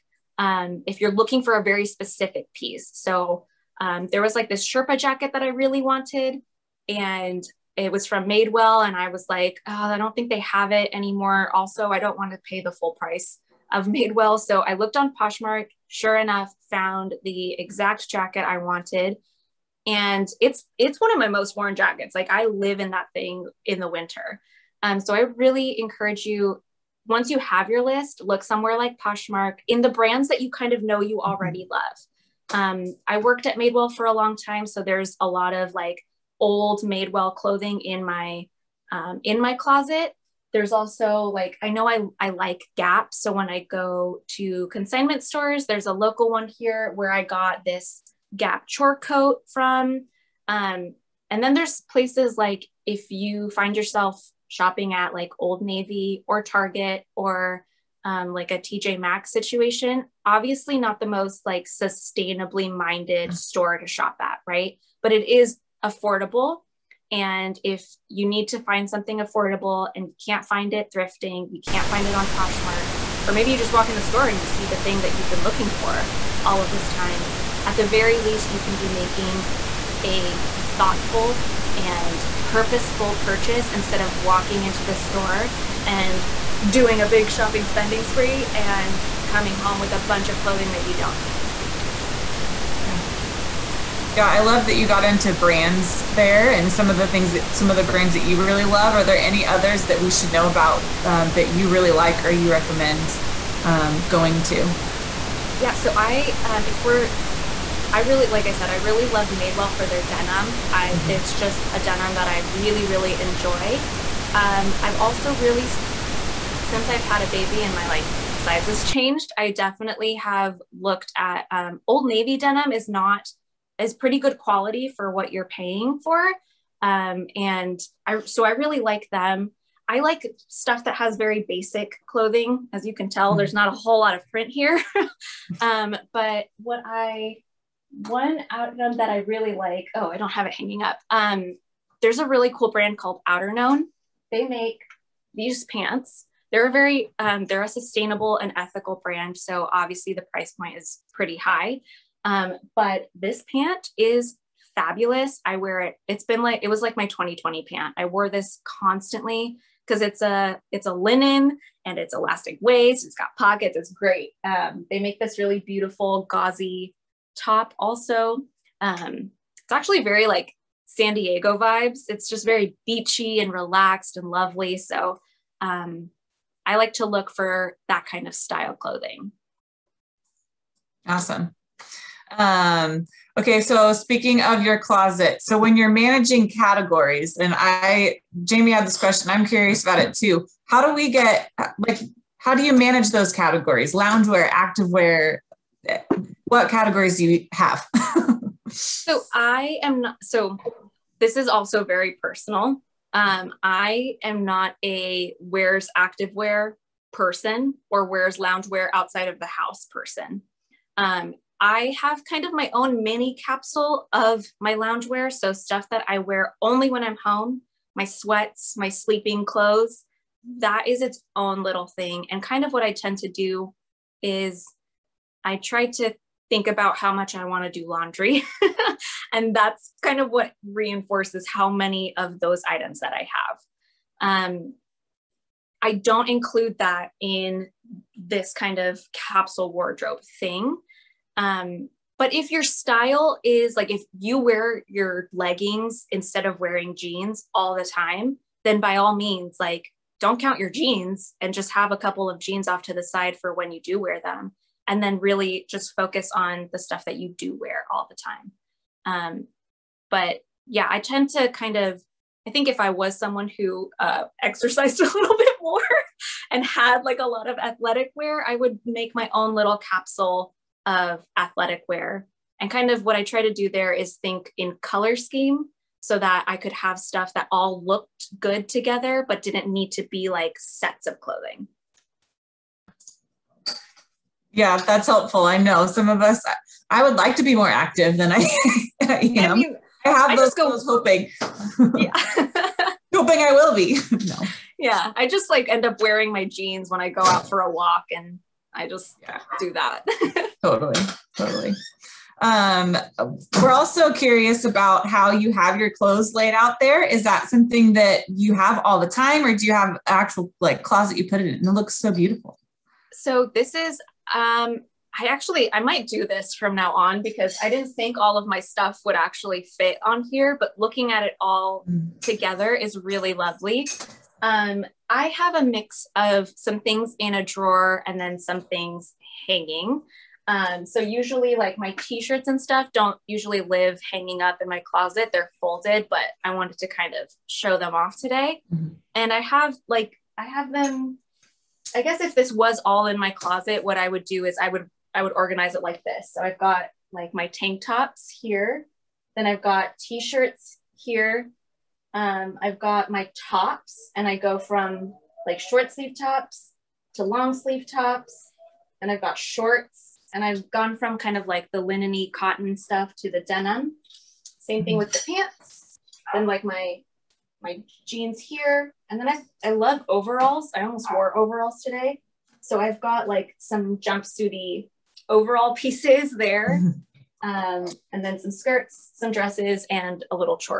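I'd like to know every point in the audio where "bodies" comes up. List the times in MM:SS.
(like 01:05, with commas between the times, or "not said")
not said.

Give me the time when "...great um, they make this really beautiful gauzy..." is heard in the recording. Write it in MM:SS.
02:43.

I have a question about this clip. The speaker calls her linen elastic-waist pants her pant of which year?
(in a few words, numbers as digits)
2020.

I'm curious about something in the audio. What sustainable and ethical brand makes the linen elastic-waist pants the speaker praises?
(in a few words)
Outerknown.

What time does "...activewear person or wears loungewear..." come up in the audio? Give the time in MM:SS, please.
03:25.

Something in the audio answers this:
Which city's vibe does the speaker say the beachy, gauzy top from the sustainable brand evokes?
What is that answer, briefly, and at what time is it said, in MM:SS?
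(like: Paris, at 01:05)
San Diego, at 02:50.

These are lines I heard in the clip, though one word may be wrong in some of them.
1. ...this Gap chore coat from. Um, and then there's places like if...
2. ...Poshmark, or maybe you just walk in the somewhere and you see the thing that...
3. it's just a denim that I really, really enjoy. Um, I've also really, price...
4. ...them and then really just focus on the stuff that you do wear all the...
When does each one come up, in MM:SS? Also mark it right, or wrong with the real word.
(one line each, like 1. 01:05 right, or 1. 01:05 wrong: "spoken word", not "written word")
1. 00:47 right
2. 01:12 wrong: "store", not "somewhere"
3. 01:51 wrong: "since", not "price"
4. 04:14 right.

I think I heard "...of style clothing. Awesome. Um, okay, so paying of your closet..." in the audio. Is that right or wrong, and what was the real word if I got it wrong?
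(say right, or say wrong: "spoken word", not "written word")
wrong: "speaking", not "paying".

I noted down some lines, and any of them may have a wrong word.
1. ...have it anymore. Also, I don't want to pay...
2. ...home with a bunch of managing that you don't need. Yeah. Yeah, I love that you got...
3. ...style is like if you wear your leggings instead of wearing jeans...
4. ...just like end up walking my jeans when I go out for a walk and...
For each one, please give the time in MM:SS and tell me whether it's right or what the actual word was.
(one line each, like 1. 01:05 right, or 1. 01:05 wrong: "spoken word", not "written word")
1. 00:10 right
2. 01:29 wrong: "clothing", not "managing"
3. 04:02 right
4. 04:55 wrong: "wearing", not "walking".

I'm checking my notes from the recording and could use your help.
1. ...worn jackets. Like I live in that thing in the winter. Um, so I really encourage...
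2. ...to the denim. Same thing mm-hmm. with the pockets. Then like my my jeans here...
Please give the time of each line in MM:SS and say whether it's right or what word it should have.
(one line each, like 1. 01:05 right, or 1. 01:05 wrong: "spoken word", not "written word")
1. 00:21 right
2. 06:03 wrong: "pants", not "pockets".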